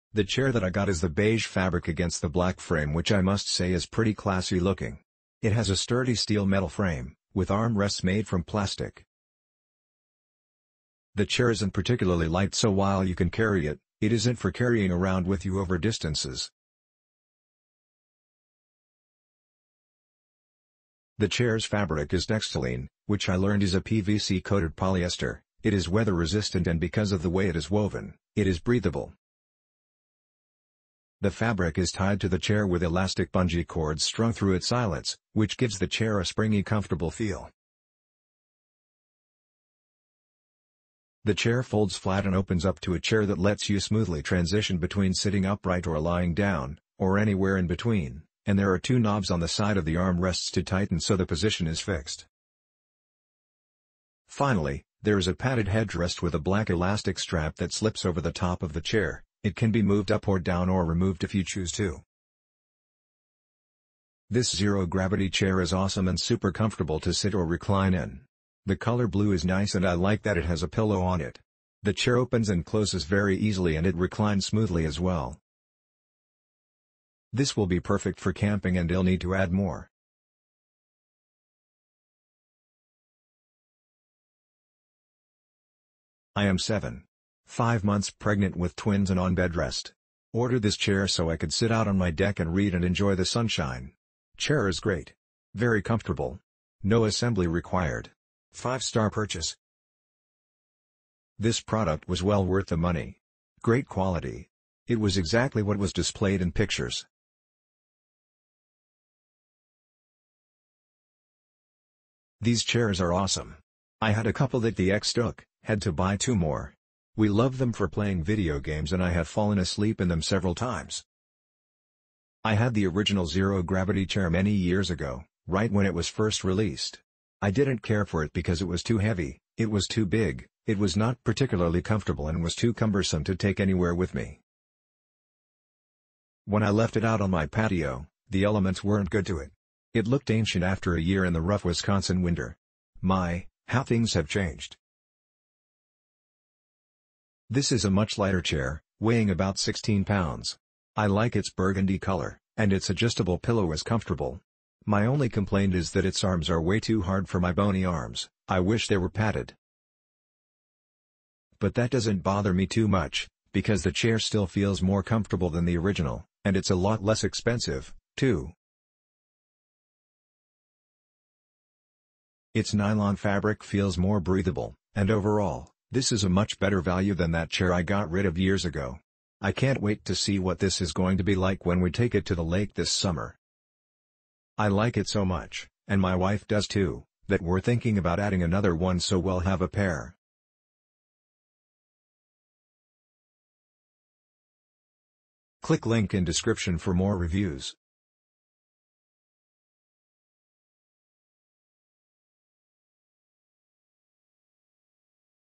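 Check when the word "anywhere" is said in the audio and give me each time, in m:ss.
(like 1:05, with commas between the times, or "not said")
0:47, 2:13.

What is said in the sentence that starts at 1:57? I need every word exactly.
We love them for playing video games and I have fallen asleep in them several times.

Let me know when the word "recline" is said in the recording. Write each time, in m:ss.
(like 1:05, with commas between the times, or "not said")
1:07, 1:13.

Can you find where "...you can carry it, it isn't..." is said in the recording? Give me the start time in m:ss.
0:13.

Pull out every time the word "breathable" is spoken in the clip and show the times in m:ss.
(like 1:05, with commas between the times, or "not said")
0:28, 2:54.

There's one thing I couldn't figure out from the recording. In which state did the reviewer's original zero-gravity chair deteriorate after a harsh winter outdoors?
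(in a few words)
Wisconsin.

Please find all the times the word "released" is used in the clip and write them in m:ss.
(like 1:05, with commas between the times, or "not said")
2:06.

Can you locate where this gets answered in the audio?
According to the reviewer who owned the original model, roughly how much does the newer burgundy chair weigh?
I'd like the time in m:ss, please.
2:29.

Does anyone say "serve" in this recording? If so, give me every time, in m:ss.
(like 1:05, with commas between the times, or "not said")
not said.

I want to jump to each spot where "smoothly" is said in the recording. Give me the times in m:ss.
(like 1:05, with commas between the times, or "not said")
0:43, 1:14.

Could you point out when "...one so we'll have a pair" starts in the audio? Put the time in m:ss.
3:08.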